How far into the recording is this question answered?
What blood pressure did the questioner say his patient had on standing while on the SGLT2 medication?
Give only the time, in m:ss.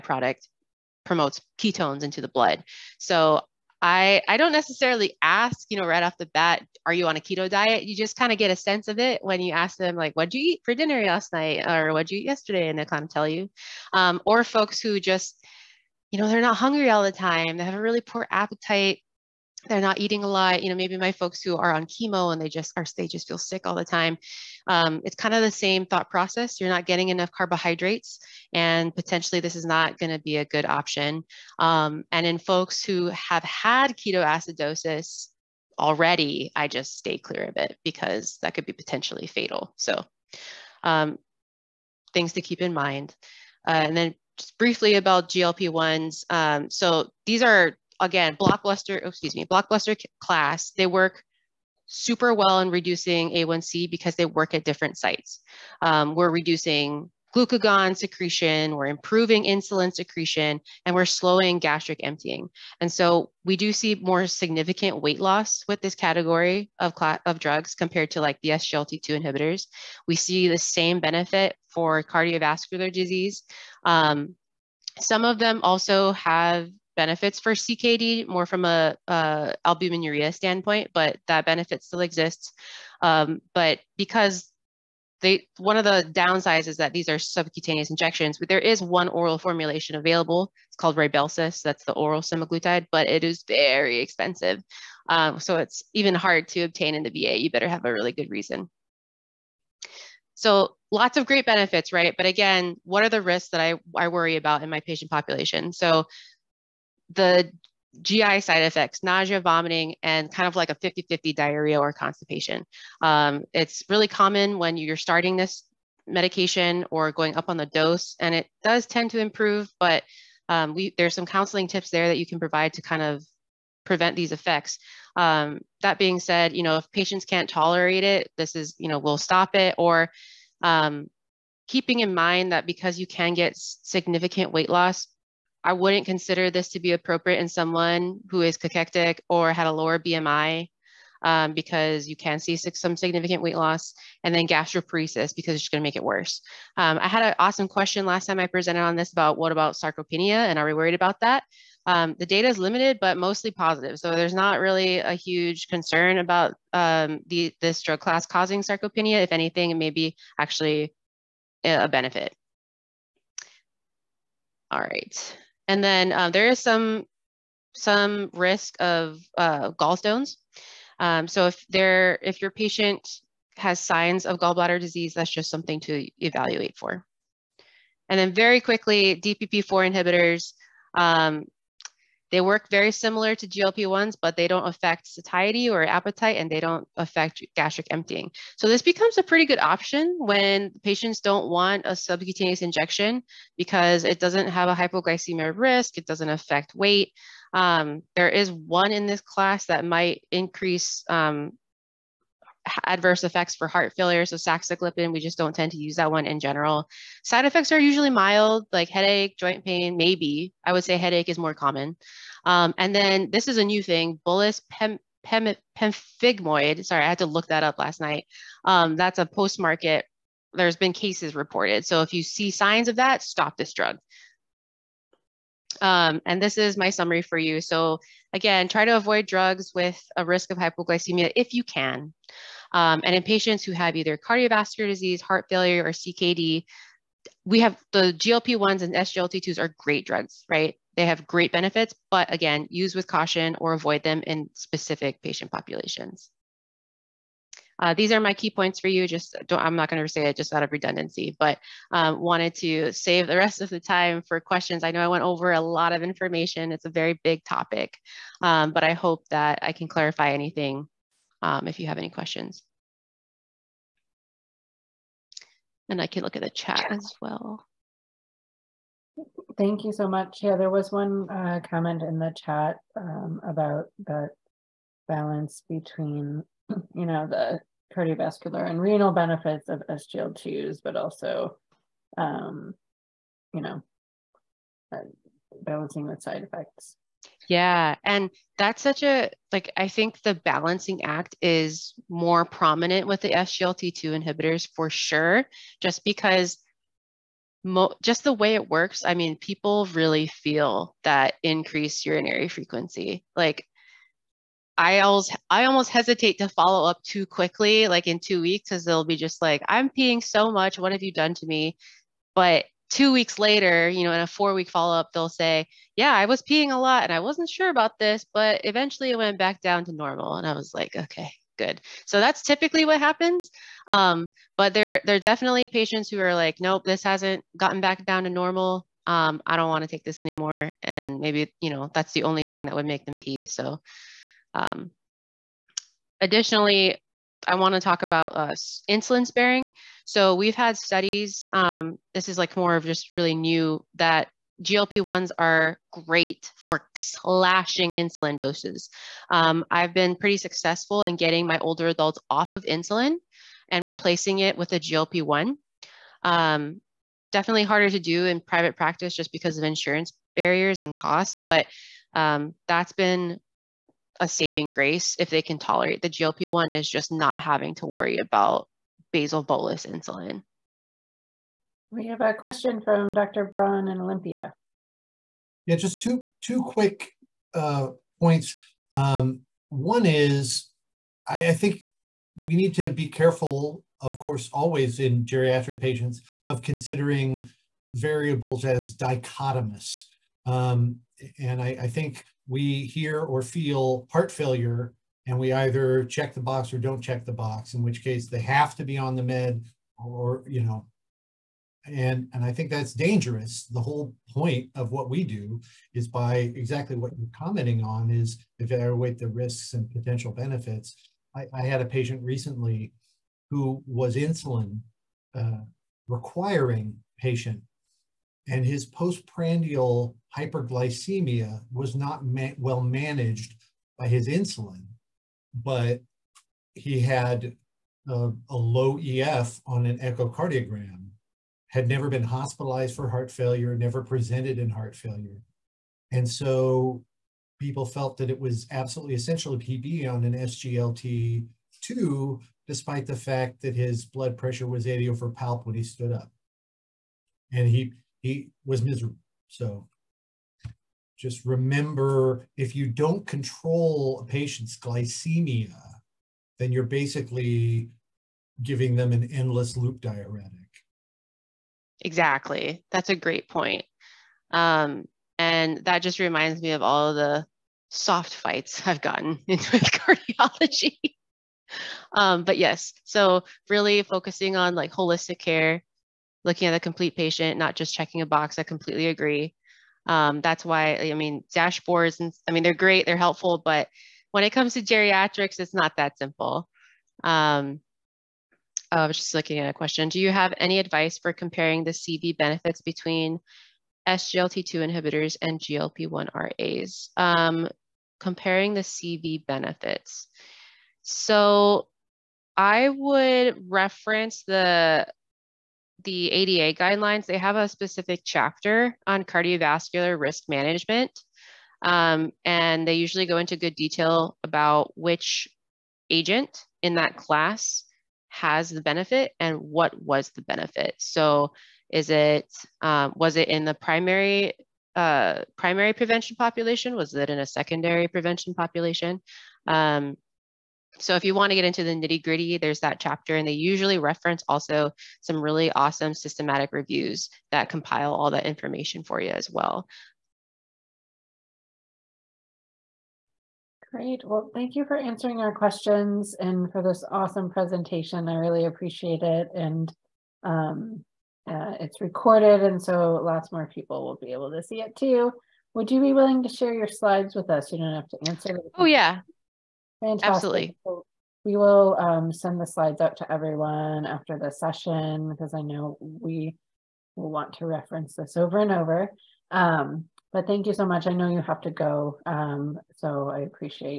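7:24.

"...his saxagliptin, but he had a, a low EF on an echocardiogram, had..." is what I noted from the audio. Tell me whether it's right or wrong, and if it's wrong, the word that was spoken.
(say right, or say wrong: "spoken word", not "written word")
wrong: "insulin", not "saxagliptin".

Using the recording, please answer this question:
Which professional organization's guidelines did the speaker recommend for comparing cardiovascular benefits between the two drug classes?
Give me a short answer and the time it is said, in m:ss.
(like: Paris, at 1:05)
ADA, at 8:26.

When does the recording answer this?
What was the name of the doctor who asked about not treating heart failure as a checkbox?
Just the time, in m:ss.
6:13.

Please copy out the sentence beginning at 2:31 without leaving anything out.
Um, the data is limited, but mostly positive.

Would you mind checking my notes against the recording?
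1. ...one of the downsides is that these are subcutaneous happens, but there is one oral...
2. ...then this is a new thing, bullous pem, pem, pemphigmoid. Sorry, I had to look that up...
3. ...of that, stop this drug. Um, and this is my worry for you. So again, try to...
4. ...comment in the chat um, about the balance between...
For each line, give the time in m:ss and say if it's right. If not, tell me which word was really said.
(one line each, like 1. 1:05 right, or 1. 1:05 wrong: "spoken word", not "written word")
1. 1:25 wrong: "injections", not "happens"
2. 3:32 right
3. 3:42 wrong: "summary", not "worry"
4. 4:31 right.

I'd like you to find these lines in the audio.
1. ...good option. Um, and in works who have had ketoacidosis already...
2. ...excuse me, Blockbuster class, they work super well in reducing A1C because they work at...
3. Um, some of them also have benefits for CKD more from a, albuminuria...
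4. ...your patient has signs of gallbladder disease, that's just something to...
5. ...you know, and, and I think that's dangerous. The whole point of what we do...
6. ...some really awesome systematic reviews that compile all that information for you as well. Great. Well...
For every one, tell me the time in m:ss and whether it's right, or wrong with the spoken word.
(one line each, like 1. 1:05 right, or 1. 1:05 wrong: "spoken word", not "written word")
1. 0:30 wrong: "folks", not "works"
2. 0:49 right
3. 1:13 right
4. 2:52 right
5. 6:40 right
6. 8:55 right.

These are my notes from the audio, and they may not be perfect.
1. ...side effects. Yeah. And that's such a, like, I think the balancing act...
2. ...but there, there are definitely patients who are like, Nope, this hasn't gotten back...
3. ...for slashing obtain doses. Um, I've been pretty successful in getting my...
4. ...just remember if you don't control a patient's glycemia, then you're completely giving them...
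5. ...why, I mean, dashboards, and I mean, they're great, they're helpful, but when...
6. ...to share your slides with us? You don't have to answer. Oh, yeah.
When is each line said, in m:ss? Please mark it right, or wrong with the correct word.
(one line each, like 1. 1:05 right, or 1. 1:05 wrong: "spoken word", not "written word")
1. 4:46 right
2. 5:24 right
3. 5:46 wrong: "insulin", not "obtain"
4. 7:31 wrong: "basically", not "completely"
5. 8:00 right
6. 9:16 right.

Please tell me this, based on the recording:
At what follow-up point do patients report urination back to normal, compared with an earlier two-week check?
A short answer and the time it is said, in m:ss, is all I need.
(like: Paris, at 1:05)
4 weeks, at 5:14.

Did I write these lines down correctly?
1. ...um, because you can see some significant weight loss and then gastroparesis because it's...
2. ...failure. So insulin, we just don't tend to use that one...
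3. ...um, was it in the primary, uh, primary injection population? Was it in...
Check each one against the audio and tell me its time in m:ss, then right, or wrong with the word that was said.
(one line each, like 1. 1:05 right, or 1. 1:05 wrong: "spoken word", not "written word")
1. 2:21 right
2. 3:23 wrong: "saxagliptin", not "insulin"
3. 8:42 wrong: "prevention", not "injection".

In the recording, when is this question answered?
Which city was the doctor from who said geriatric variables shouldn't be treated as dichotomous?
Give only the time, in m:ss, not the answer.
6:14.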